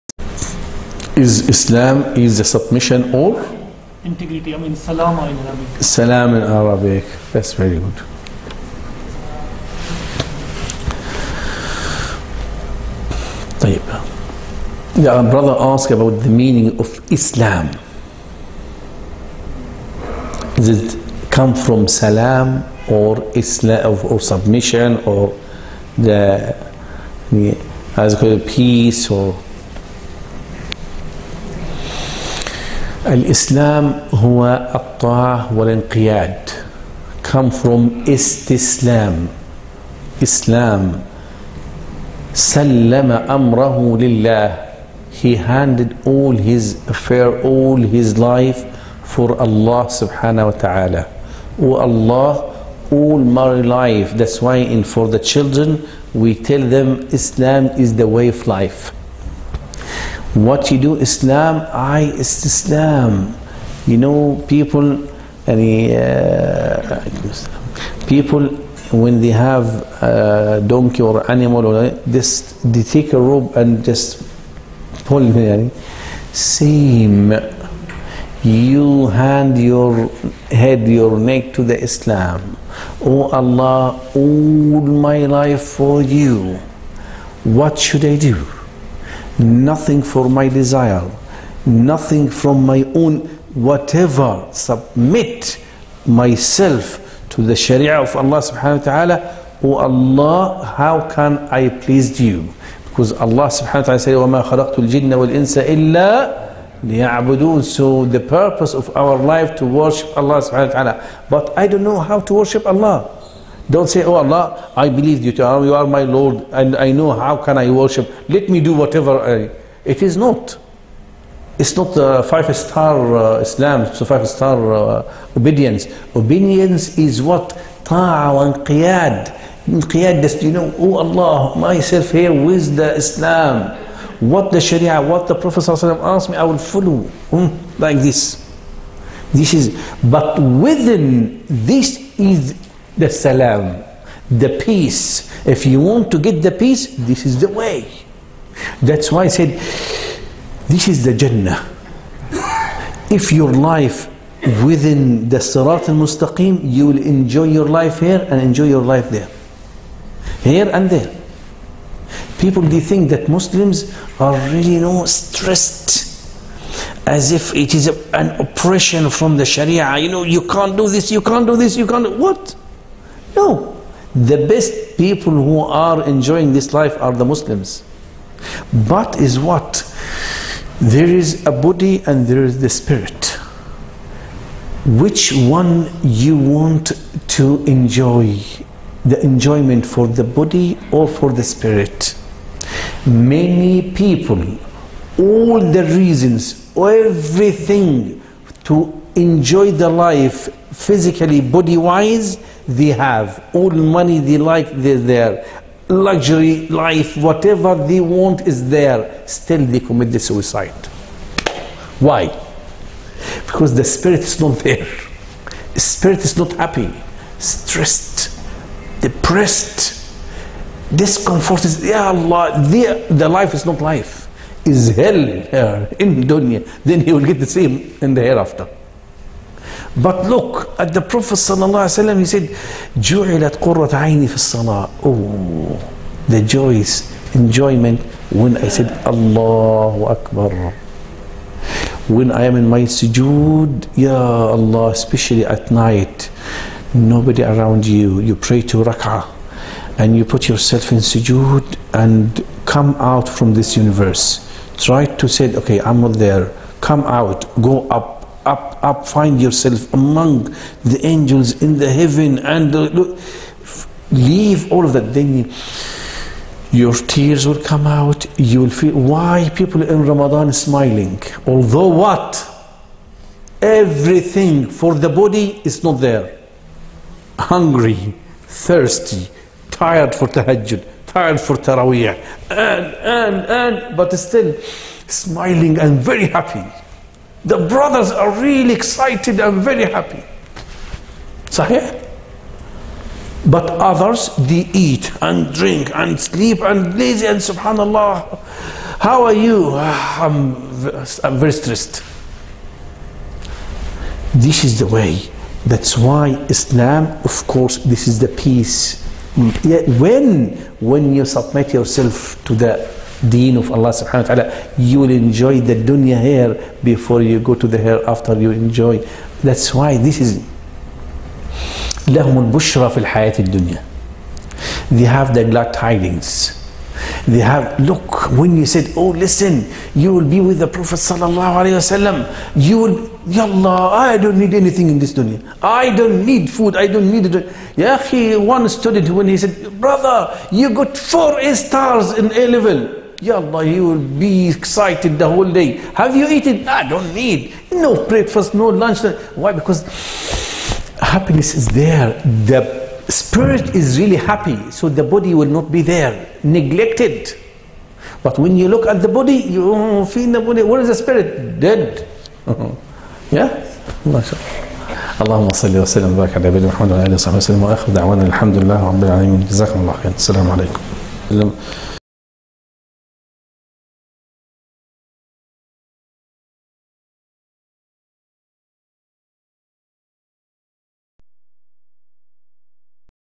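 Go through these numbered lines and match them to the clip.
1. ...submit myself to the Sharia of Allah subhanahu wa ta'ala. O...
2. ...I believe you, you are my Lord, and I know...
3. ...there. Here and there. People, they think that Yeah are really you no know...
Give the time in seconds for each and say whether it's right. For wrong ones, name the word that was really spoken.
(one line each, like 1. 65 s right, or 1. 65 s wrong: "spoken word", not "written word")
1. 94 s right
2. 114 s right
3. 159 s wrong: "Muslims", not "Yeah".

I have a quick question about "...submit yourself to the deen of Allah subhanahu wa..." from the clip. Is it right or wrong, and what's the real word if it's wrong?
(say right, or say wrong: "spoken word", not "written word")
right.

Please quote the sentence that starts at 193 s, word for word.
Many people, all the reasons, everything to enjoy the life physically, body-wise, they have.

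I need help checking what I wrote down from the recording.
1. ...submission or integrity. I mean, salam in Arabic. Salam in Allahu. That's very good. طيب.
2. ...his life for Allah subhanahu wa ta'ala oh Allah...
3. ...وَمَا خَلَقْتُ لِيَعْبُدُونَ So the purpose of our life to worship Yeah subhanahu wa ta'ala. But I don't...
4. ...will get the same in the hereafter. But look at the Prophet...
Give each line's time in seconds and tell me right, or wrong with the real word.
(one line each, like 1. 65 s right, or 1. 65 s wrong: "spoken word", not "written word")
1. 2 s wrong: "Arabic", not "Allahu"
2. 47 s right
3. 104 s wrong: "Allah", not "Yeah"
4. 227 s right.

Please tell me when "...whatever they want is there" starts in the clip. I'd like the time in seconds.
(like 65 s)
207 s.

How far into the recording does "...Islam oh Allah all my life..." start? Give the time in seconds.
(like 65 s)
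81 s.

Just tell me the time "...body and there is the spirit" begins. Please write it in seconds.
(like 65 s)
181 s.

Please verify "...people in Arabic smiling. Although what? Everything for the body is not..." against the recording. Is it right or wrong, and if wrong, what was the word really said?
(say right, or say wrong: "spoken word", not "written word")
wrong: "Ramadan", not "Arabic".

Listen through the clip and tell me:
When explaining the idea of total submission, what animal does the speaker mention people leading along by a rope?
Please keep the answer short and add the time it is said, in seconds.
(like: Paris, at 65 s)
Donkey, at 70 s.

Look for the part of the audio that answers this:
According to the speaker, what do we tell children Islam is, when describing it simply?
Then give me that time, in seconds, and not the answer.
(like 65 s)
57 s.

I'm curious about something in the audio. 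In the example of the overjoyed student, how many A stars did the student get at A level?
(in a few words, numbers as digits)
4.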